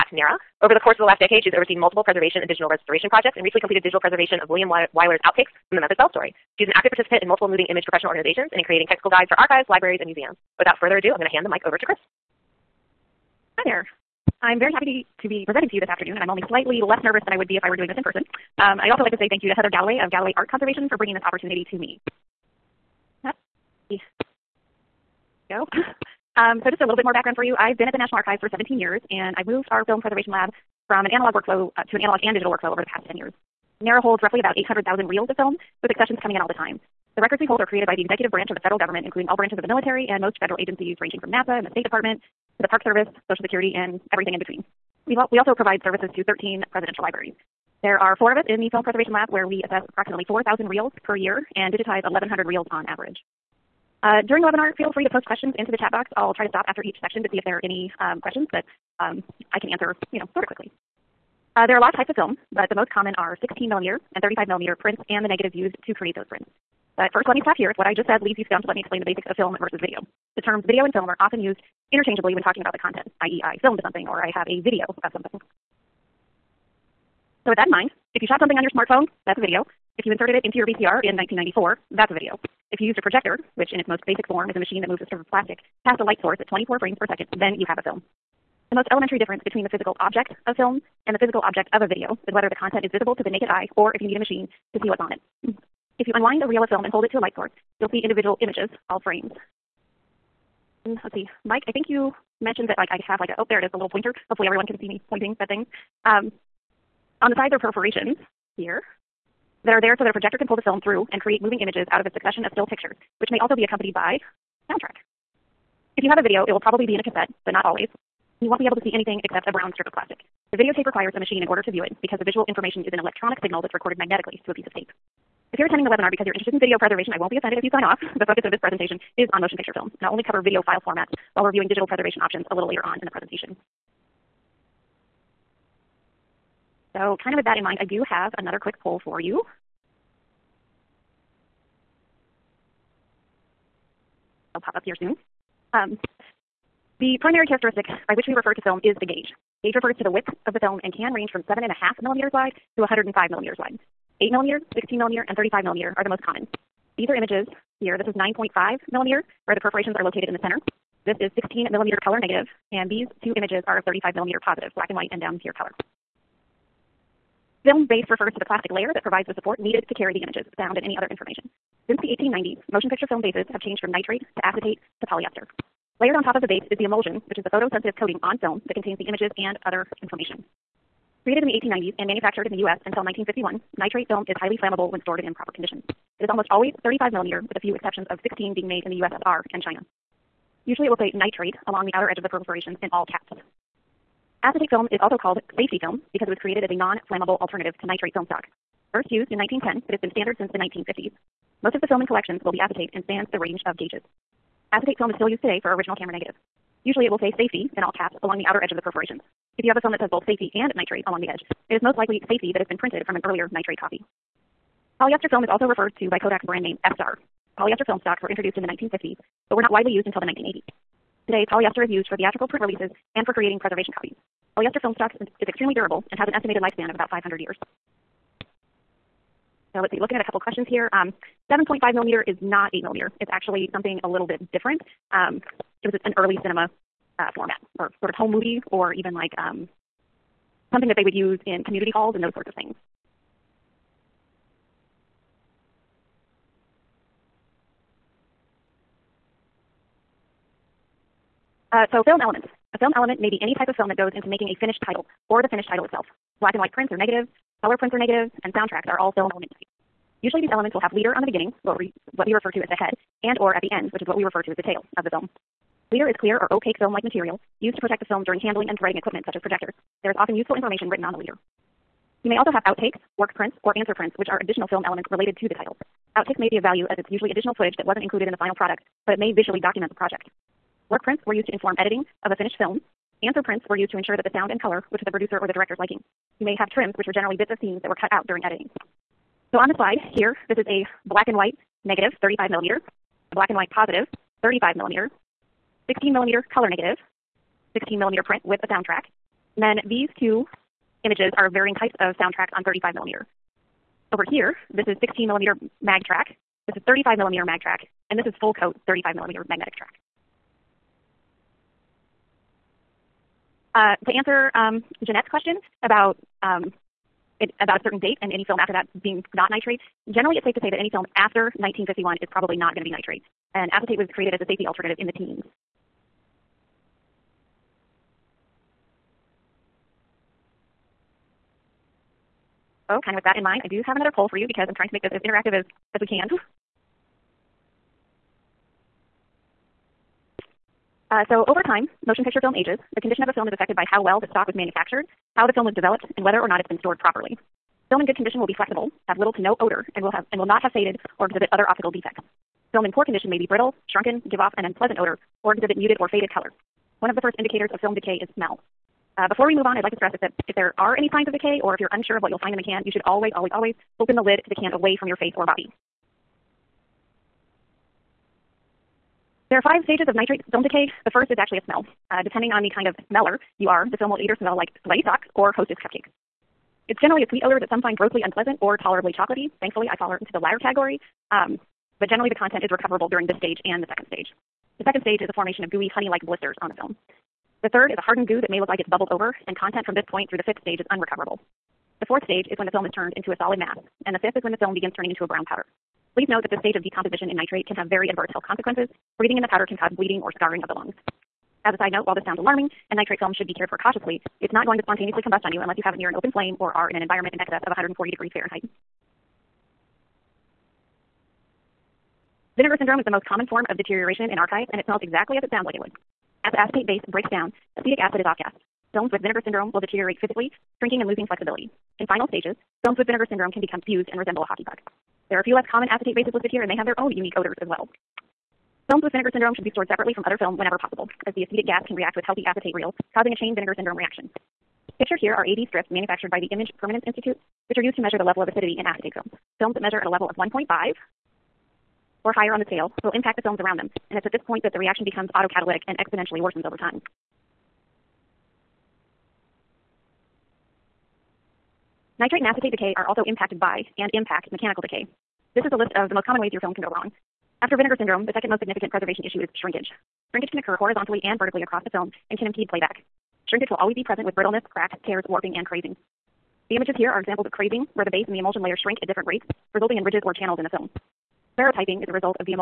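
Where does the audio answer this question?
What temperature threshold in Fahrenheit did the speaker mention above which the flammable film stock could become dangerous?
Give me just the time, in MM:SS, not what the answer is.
06:47.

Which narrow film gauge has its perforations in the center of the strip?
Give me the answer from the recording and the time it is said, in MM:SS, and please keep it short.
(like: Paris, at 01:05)
9.5 millimeter, at 02:38.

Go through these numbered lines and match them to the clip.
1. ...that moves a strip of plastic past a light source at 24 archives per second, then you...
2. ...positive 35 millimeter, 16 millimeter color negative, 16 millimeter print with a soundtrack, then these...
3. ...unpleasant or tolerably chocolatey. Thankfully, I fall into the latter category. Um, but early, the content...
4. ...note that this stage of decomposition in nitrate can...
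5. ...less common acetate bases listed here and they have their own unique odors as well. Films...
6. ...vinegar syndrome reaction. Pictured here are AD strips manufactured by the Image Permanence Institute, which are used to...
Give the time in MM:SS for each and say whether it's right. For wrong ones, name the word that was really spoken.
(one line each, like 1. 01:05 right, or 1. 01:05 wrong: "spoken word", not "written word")
1. 01:24 wrong: "frames", not "archives"
2. 04:53 right
3. 06:18 wrong: "generally", not "early"
4. 06:36 right
5. 07:05 right
6. 07:13 right.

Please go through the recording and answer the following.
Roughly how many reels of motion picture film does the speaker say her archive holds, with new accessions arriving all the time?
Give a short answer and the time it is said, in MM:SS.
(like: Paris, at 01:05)
800,000, at 00:34.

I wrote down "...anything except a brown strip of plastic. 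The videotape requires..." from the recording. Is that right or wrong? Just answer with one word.
right.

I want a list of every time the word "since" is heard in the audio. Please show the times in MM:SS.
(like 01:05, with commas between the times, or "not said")
02:51, 03:20.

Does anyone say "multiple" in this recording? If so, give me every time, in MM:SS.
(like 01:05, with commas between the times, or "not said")
00:01, 00:07.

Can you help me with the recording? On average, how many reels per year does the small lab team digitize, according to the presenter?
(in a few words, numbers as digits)
1,100.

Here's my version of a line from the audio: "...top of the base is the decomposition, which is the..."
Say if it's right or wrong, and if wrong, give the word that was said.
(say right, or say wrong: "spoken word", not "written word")
wrong: "emulsion", not "decomposition".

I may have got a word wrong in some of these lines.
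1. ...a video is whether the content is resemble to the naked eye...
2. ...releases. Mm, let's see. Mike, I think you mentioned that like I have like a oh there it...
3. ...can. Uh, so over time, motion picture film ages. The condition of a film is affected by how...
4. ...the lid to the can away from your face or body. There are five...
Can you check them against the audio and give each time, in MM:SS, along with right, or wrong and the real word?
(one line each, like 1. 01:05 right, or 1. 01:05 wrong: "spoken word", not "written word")
1. 01:31 wrong: "visible", not "resemble"
2. 01:39 wrong: "frames", not "releases"
3. 05:36 right
4. 06:04 right.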